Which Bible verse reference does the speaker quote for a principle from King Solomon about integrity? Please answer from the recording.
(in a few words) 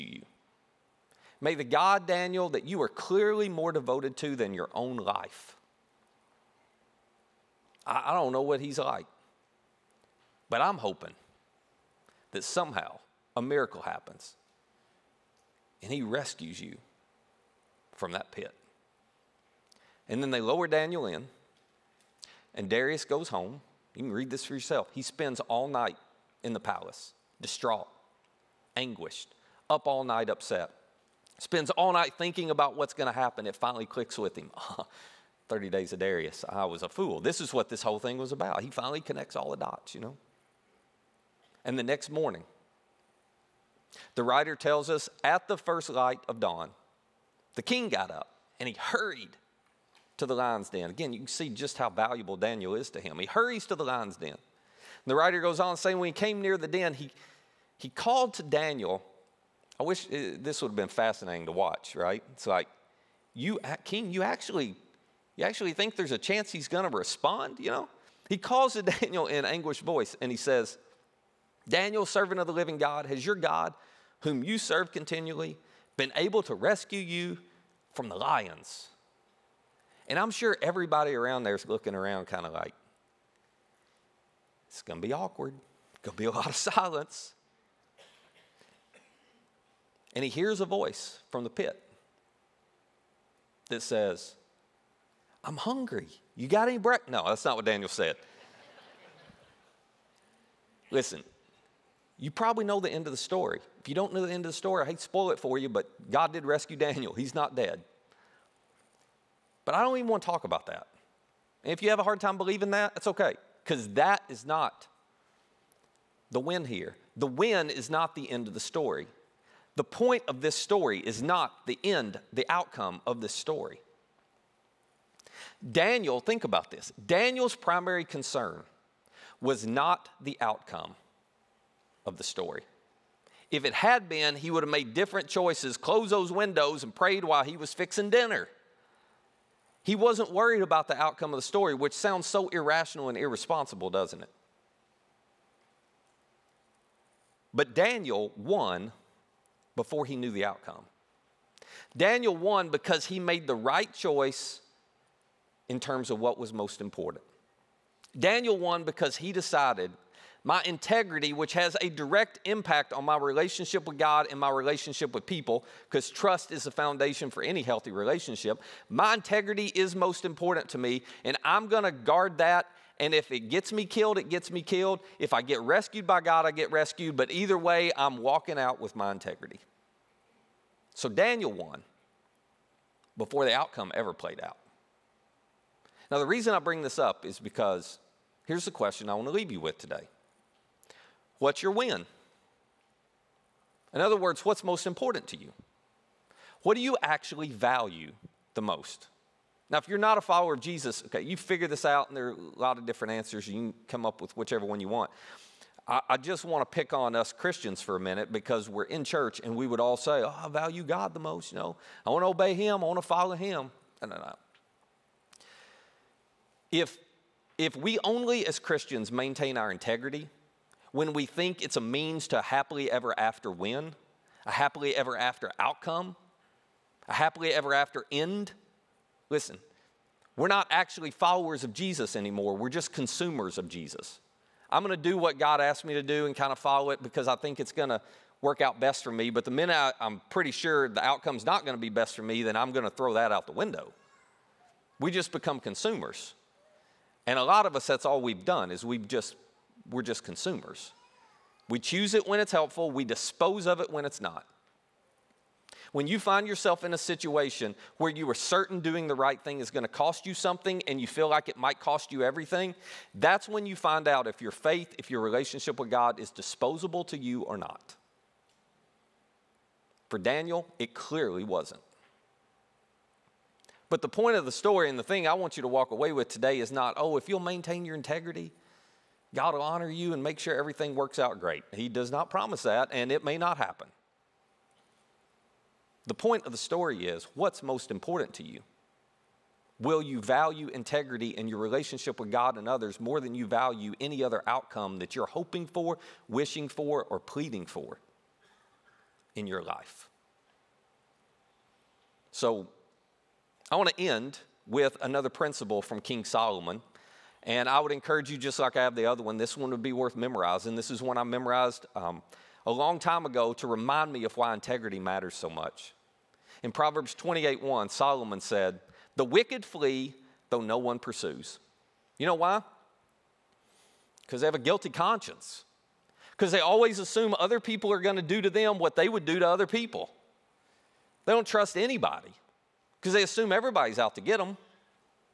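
Proverbs 28:1.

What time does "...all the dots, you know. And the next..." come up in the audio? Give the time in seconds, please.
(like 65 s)
39 s.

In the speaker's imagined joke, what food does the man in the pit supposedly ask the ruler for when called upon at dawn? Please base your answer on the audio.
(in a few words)
Bread.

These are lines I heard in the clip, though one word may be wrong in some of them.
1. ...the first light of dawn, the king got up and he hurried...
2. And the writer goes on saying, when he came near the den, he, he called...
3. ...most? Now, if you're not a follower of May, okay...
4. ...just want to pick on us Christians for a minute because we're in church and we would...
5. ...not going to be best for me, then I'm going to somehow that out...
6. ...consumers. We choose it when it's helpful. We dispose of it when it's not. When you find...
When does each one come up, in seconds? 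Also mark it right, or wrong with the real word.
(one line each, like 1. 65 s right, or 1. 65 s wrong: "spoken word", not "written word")
1. 45 s right
2. 54 s right
3. 198 s wrong: "Jesus", not "May"
4. 206 s right
5. 241 s wrong: "throw", not "somehow"
6. 250 s right.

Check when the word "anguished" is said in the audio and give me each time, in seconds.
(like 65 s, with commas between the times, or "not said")
28 s, 69 s.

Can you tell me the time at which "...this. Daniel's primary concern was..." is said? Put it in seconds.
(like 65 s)
126 s.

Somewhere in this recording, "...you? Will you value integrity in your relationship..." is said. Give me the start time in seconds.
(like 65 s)
288 s.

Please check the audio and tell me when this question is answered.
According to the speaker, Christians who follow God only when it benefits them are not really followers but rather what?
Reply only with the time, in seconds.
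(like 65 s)
232 s.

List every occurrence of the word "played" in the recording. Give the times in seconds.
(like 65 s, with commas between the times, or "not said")
184 s.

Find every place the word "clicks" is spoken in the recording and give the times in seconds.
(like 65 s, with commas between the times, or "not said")
33 s.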